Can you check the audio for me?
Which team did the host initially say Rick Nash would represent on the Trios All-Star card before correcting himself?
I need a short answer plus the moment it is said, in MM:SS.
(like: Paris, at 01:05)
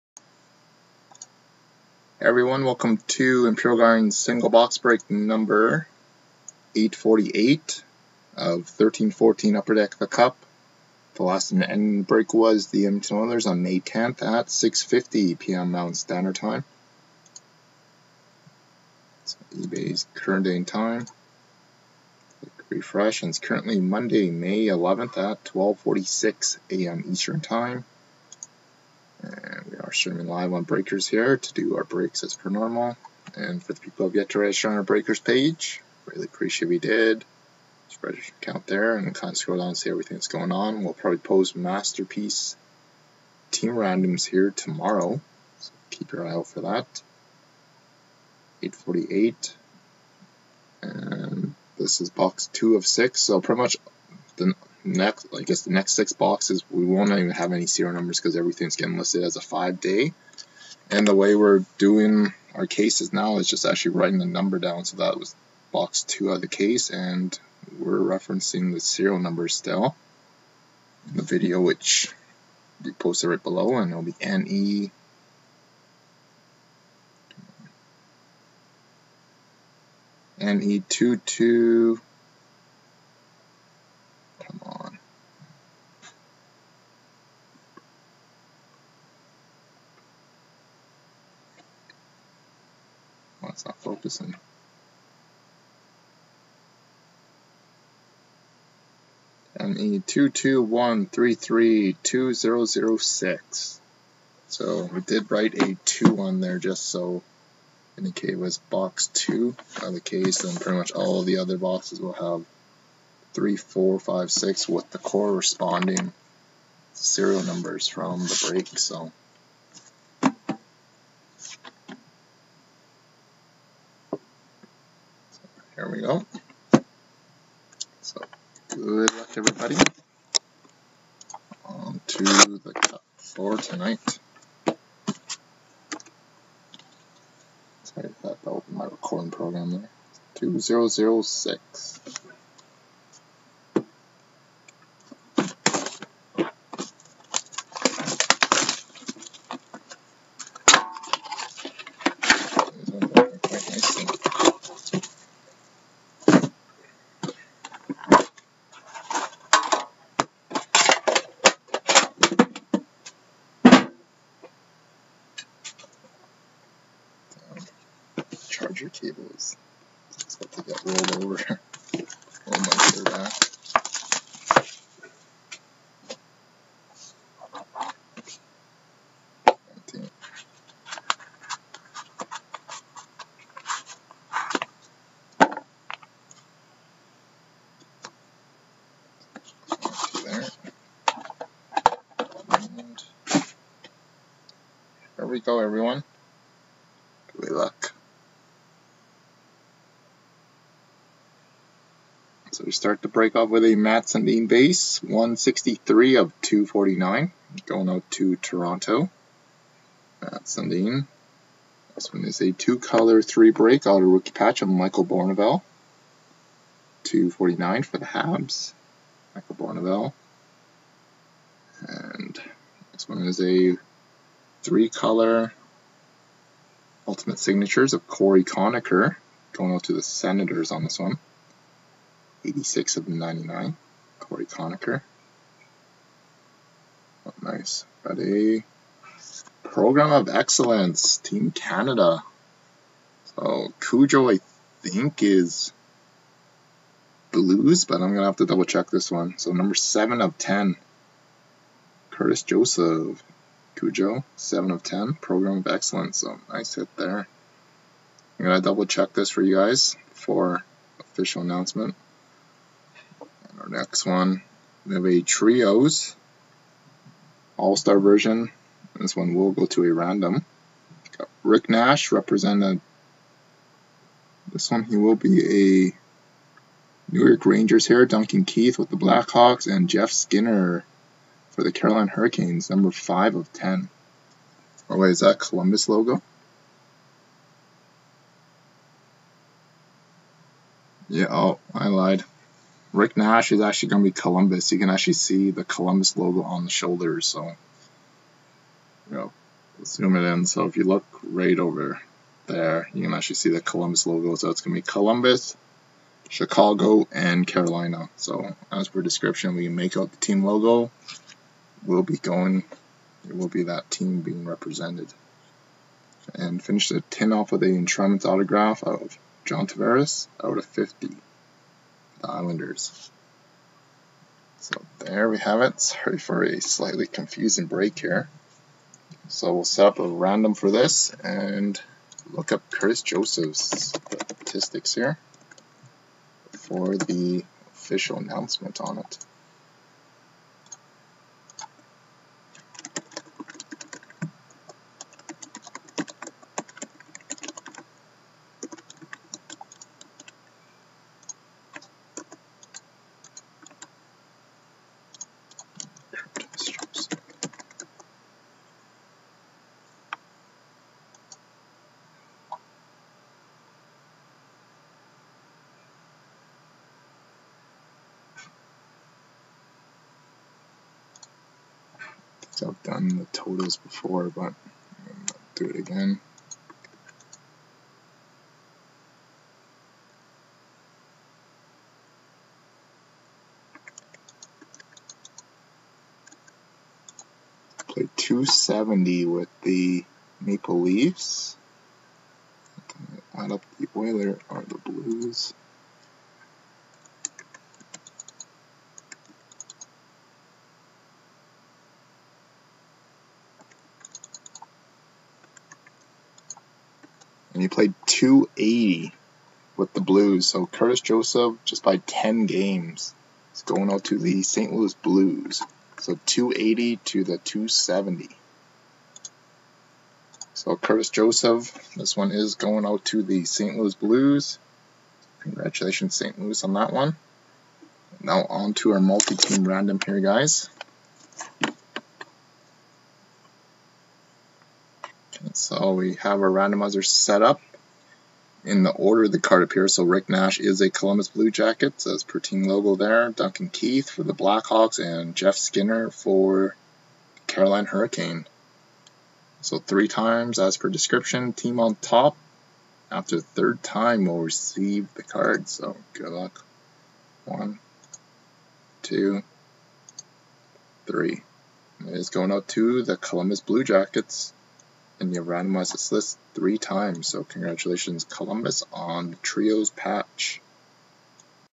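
New York Rangers, at 04:37.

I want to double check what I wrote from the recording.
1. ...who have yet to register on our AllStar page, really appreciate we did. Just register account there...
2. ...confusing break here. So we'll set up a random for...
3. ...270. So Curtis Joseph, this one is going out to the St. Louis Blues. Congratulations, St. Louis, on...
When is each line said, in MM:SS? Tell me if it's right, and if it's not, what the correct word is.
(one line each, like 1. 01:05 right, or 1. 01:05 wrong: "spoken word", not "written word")
1. 00:33 wrong: "Breakers", not "AllStar"
2. 05:27 right
3. 06:57 right.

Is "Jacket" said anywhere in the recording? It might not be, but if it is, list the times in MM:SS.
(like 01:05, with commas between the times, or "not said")
07:21, 07:43.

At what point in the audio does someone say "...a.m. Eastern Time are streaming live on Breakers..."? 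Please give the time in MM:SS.
00:26.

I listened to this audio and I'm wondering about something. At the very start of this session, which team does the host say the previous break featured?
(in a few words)
Edmonton Oilers.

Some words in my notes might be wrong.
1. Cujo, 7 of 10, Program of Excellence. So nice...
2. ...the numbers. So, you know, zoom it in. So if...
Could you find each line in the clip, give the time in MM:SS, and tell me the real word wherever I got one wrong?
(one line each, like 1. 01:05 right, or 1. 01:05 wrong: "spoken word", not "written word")
1. 04:13 right
2. 04:56 wrong: "shoulders", not "numbers".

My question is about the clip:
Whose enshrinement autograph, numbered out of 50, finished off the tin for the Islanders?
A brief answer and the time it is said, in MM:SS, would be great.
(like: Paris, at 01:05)
John Tavares, at 05:19.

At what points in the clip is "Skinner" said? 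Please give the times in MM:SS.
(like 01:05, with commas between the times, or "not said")
04:40, 07:25.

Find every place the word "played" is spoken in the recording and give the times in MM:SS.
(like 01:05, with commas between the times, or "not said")
06:27, 06:47.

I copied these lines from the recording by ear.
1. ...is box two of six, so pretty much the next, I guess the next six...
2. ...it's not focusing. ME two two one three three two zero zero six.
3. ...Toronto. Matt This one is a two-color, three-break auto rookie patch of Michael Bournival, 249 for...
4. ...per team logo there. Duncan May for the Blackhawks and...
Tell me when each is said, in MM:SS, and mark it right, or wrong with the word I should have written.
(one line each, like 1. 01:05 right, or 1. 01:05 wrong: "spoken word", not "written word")
1. 00:51 right
2. 01:33 right
3. 03:28 right
4. 07:22 wrong: "Keith", not "May".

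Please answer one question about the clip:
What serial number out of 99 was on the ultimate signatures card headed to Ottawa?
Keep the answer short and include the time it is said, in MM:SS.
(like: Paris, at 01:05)
86, at 03:52.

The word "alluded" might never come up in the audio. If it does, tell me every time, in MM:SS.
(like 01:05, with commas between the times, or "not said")
not said.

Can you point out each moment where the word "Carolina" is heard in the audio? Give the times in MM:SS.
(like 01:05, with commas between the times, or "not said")
04:41, 05:07, 07:27.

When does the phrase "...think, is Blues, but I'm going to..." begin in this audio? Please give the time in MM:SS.
04:04.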